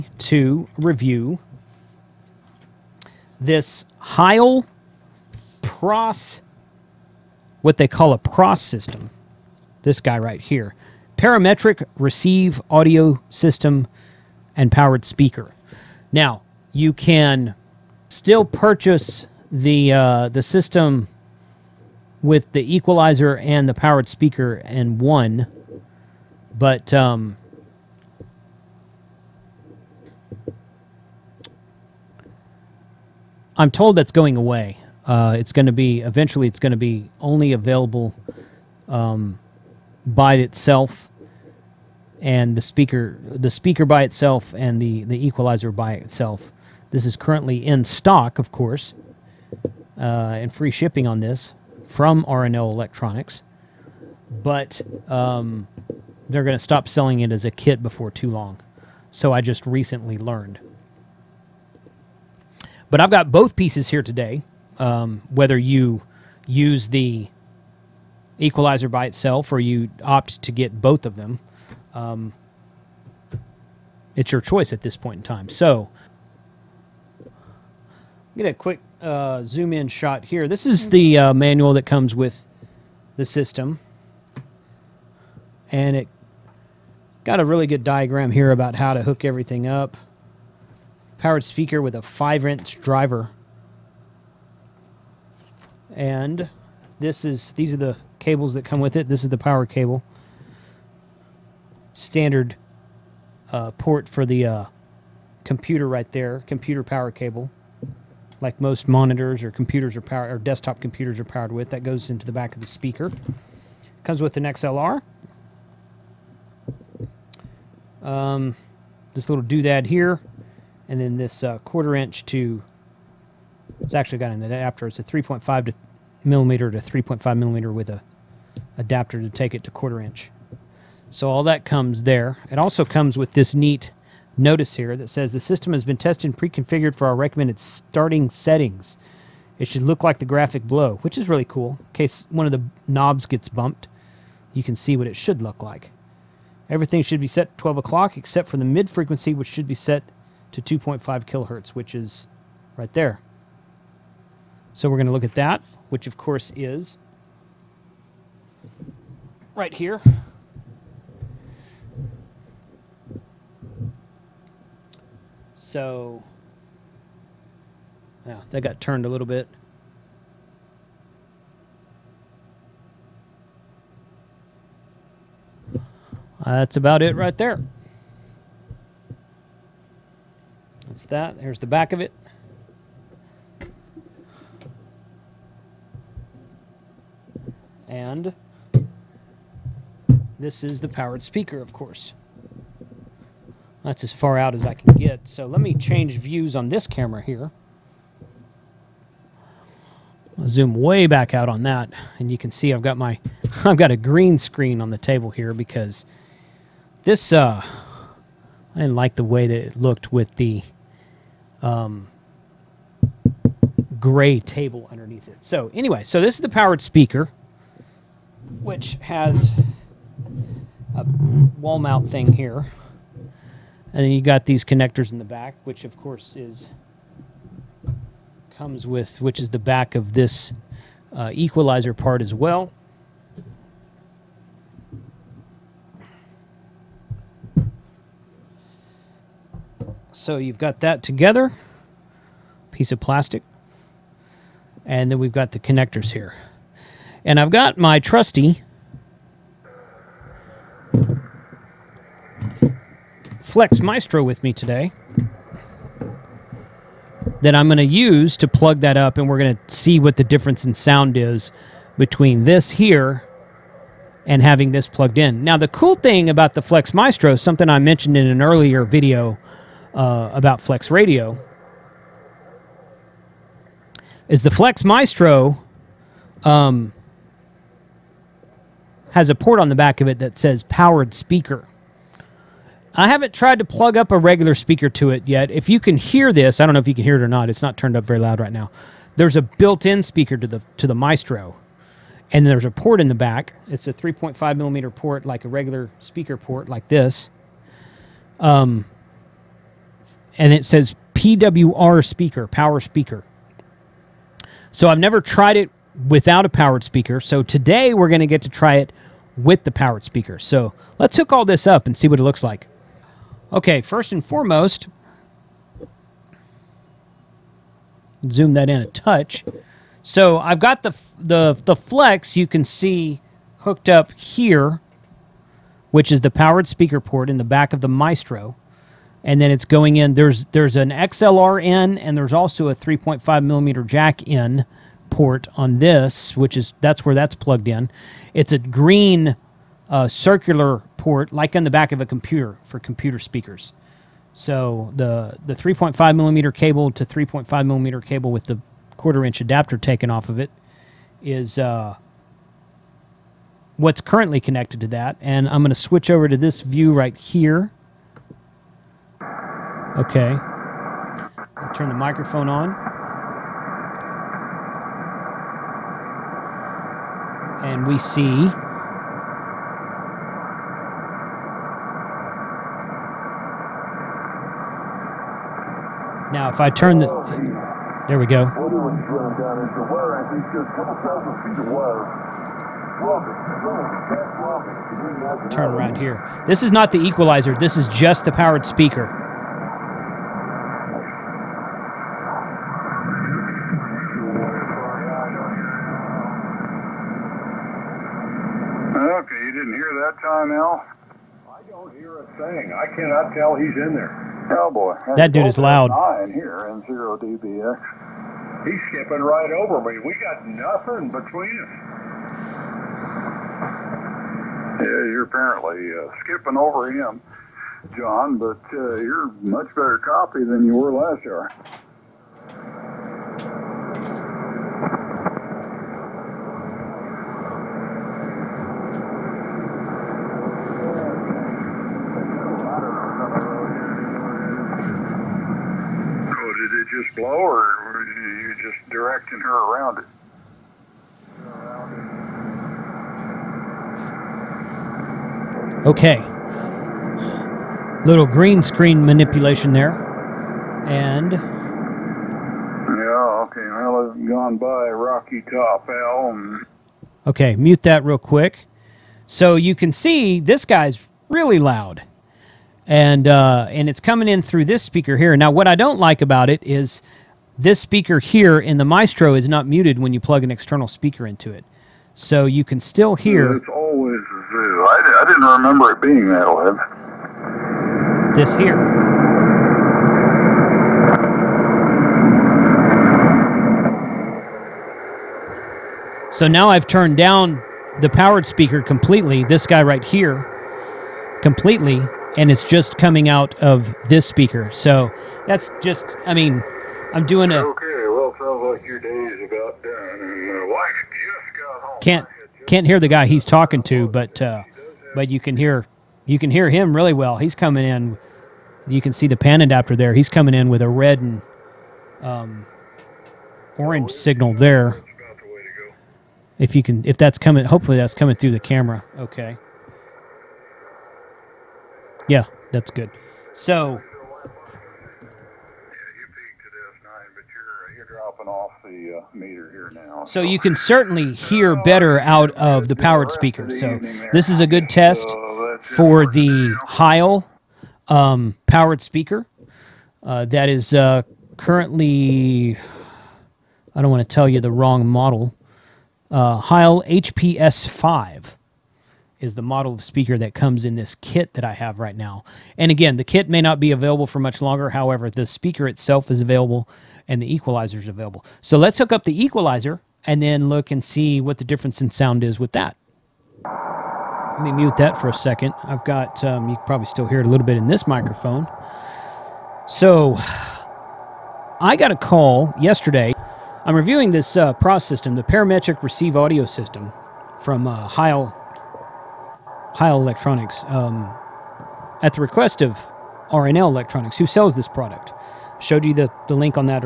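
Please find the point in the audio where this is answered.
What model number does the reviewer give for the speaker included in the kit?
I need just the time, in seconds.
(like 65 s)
546 s.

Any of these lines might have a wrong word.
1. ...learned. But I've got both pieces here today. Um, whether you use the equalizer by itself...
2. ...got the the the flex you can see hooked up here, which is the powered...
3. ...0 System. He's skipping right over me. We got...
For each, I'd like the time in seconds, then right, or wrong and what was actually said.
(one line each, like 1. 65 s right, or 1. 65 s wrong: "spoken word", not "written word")
1. 60 s right
2. 320 s right
3. 406 s wrong: "DBX", not "System".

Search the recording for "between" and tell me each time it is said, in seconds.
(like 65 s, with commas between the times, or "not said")
261 s, 411 s.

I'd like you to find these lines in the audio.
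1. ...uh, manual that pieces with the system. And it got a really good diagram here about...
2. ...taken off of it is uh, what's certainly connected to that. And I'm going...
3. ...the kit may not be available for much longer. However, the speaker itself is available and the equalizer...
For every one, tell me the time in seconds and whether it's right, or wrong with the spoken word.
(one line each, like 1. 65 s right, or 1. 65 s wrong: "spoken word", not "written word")
1. 81 s wrong: "comes", not "pieces"
2. 349 s wrong: "currently", not "certainly"
3. 553 s right.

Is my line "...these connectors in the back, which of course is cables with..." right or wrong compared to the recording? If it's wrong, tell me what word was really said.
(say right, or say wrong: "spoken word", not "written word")
wrong: "comes", not "cables".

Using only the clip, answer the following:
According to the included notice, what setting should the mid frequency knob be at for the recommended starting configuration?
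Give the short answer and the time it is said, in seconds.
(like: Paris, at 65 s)
2.5 kilohertz, at 150 s.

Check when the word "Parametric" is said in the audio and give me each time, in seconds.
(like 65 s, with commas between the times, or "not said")
11 s, 575 s.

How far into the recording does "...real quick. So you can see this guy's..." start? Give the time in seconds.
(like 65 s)
458 s.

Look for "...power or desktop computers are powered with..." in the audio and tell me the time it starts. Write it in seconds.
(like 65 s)
110 s.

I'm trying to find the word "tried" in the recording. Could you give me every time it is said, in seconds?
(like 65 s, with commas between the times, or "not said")
283 s, 305 s.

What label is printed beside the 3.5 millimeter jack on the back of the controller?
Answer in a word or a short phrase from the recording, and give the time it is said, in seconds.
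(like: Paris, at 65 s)
PWR speaker, at 301 s.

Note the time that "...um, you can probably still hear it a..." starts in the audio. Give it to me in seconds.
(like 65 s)
566 s.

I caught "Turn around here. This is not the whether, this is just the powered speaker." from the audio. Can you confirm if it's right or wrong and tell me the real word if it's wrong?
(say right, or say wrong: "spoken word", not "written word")
wrong: "equalizer", not "whether".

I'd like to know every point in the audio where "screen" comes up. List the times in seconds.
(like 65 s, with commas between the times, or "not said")
204 s, 448 s.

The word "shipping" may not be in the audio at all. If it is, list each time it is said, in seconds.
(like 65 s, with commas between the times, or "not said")
50 s.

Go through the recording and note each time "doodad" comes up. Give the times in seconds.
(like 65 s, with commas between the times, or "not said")
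119 s.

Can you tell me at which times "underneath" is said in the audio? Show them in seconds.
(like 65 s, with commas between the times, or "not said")
214 s.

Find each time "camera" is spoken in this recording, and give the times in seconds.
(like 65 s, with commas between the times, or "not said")
196 s, 518 s.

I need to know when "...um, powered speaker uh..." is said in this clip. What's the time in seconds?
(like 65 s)
538 s.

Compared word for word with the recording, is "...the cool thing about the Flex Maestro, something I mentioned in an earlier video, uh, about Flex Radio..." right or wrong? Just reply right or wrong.
right.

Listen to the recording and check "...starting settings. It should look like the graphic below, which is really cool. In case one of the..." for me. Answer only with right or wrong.
right.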